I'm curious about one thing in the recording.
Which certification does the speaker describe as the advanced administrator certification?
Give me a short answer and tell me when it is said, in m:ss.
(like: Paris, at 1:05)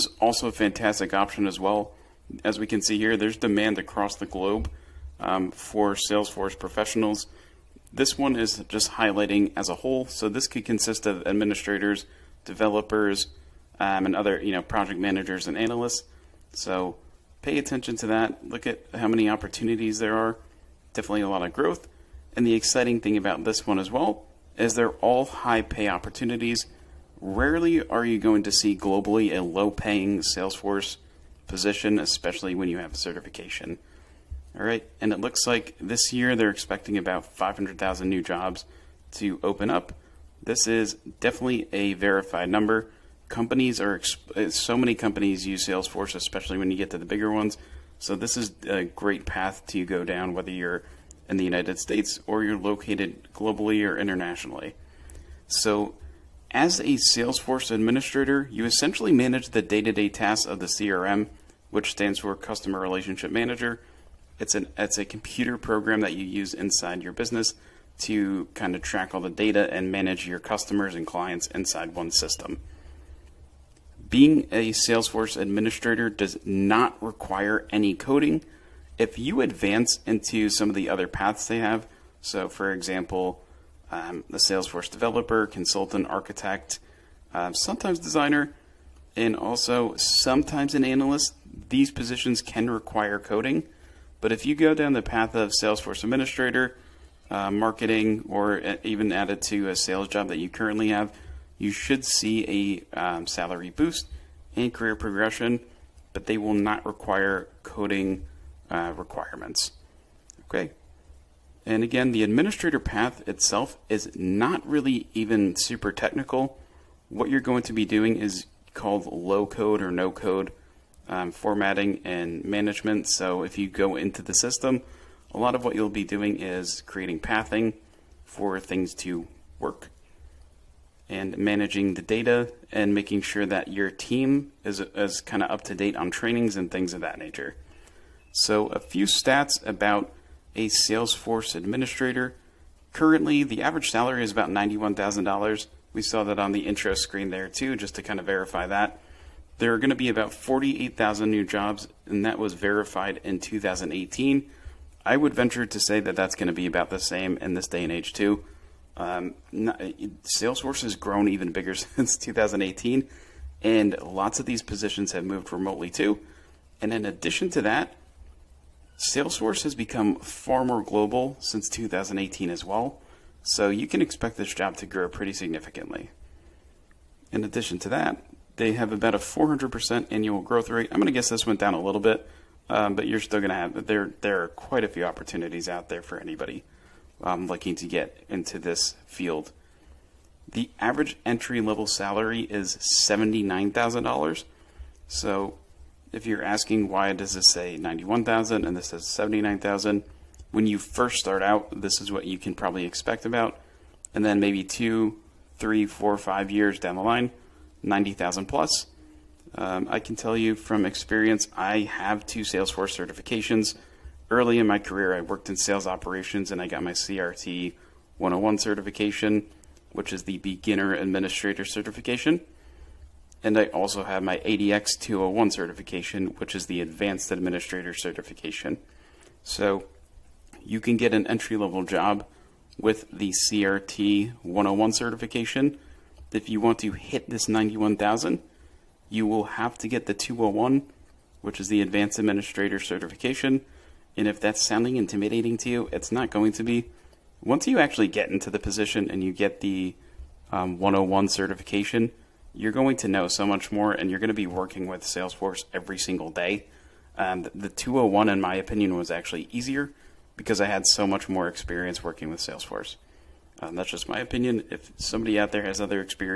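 ADX 201, at 3:44.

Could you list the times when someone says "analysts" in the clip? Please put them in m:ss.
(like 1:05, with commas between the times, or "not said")
0:15, 1:30.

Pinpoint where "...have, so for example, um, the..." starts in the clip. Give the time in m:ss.
1:21.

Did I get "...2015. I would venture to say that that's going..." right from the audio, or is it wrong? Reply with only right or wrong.
wrong.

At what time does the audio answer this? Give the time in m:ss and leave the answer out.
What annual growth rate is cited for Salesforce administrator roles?
2:59.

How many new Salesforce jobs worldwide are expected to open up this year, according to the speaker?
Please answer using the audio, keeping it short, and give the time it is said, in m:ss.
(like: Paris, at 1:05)
500,000, at 0:37.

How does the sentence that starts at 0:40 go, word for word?
This is definitely a verified number companies are so many companies use Salesforce, especially when you get to the bigger ones.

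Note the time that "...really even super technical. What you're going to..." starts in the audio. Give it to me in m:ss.
1:54.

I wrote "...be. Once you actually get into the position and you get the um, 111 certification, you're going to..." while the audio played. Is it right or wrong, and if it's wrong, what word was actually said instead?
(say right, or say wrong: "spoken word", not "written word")
wrong: "101", not "111".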